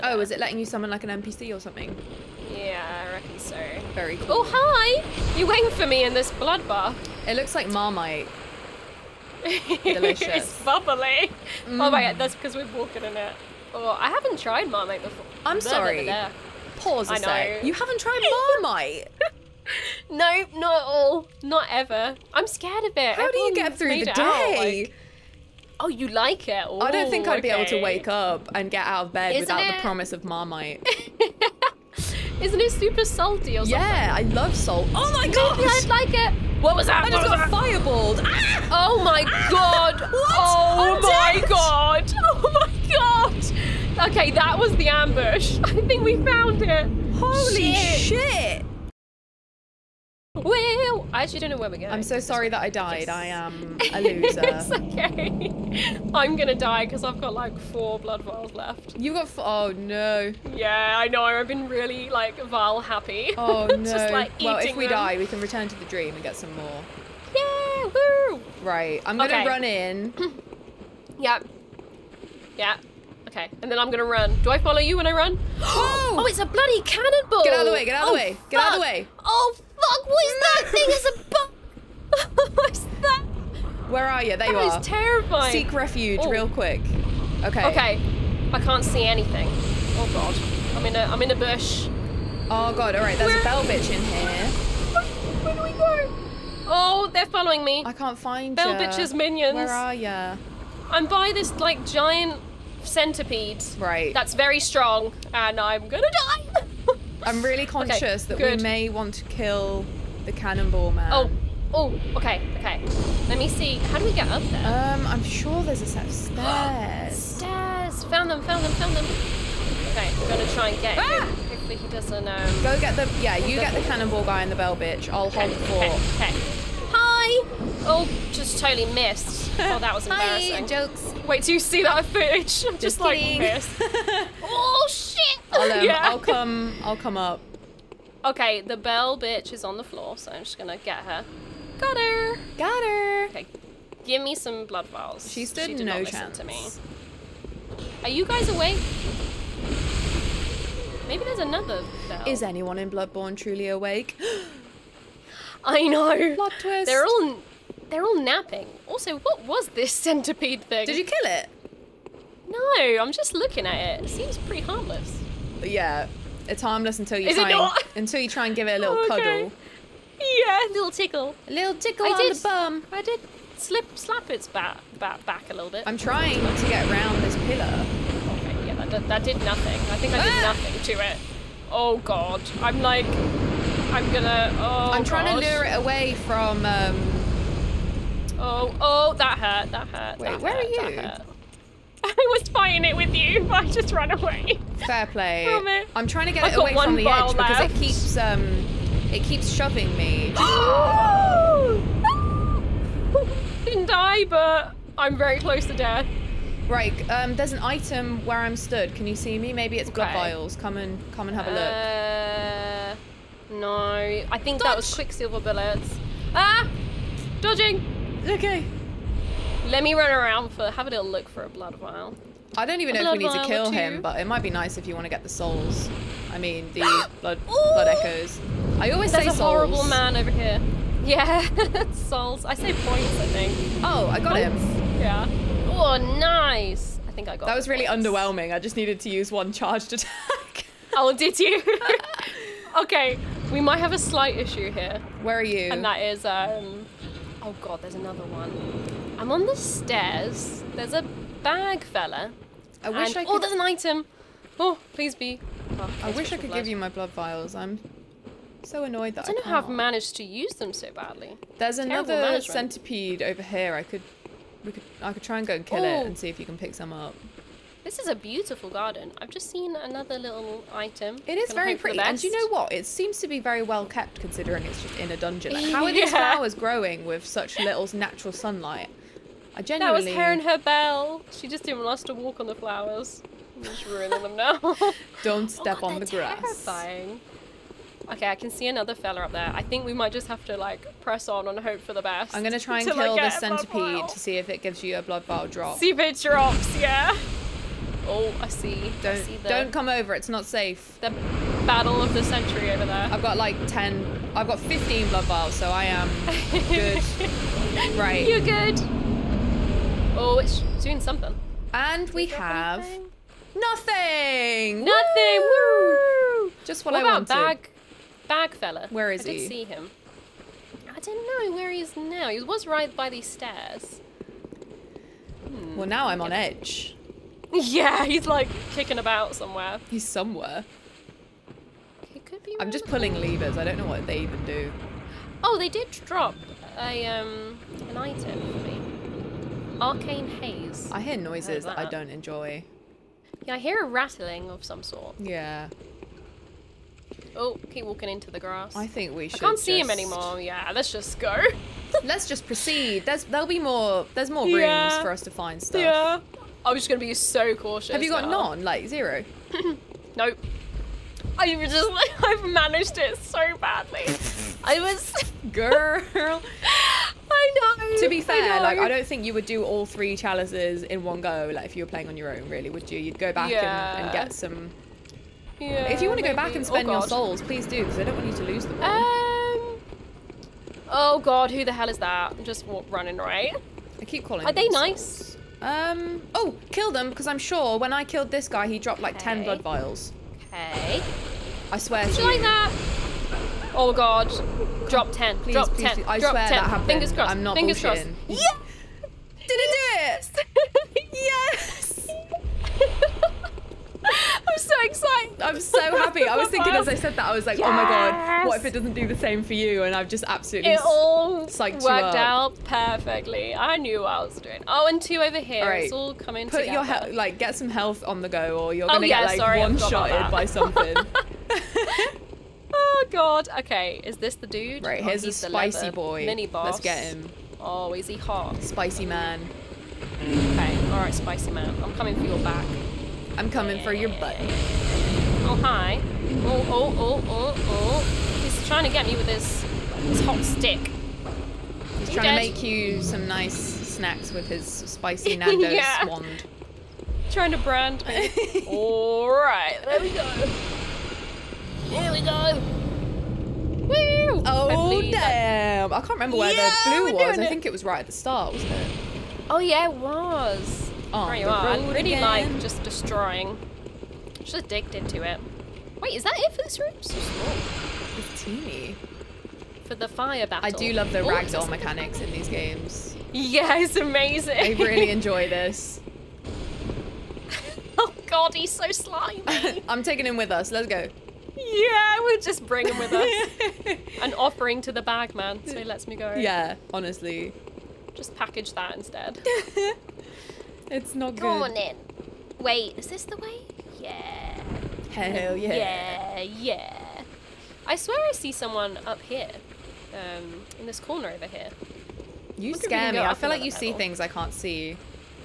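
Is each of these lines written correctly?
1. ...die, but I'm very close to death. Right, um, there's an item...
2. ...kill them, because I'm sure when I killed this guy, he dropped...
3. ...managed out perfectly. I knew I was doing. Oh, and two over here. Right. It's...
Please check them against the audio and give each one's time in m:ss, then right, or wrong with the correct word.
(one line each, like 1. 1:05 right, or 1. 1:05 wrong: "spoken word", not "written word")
1. 3:23 right
2. 6:26 right
3. 6:51 wrong: "worked", not "managed".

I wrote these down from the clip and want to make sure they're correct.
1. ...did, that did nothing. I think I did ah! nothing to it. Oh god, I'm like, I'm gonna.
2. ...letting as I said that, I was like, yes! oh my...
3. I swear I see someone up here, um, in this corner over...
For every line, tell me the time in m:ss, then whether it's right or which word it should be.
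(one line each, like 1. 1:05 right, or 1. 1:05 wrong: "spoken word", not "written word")
1. 2:58 right
2. 6:46 wrong: "thinking", not "letting"
3. 8:17 right.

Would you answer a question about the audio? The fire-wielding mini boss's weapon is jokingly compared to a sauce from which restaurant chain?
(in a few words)
Nando's.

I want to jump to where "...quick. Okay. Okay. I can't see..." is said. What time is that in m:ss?
1:26.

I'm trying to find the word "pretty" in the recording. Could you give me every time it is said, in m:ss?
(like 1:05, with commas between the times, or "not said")
2:44, 4:31.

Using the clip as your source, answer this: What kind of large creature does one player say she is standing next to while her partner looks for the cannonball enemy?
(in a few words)
Giant centipede.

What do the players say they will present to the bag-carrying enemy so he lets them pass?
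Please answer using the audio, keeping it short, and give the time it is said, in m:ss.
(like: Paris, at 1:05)
An offering, at 8:04.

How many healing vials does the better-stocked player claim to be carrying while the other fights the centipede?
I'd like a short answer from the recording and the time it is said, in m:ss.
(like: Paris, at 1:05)
15, at 5:04.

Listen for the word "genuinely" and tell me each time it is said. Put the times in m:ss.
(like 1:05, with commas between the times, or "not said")
4:39.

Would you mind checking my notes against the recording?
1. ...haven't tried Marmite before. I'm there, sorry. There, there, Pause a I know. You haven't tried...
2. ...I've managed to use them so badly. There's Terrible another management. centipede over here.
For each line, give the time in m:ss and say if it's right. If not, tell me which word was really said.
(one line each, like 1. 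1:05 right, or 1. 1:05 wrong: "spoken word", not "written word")
1. 0:14 right
2. 4:19 right.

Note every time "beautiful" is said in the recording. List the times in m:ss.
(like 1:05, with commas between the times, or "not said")
4:28.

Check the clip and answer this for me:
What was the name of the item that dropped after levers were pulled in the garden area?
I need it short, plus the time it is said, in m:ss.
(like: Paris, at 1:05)
Arcane haze, at 5:39.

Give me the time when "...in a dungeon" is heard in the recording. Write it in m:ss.
4:34.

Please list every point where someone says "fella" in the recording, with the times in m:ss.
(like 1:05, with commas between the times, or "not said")
4:11, 4:48, 5:18.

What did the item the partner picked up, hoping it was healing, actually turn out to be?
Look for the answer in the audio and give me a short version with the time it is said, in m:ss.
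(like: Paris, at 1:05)
Quicksilver bullets, at 3:34.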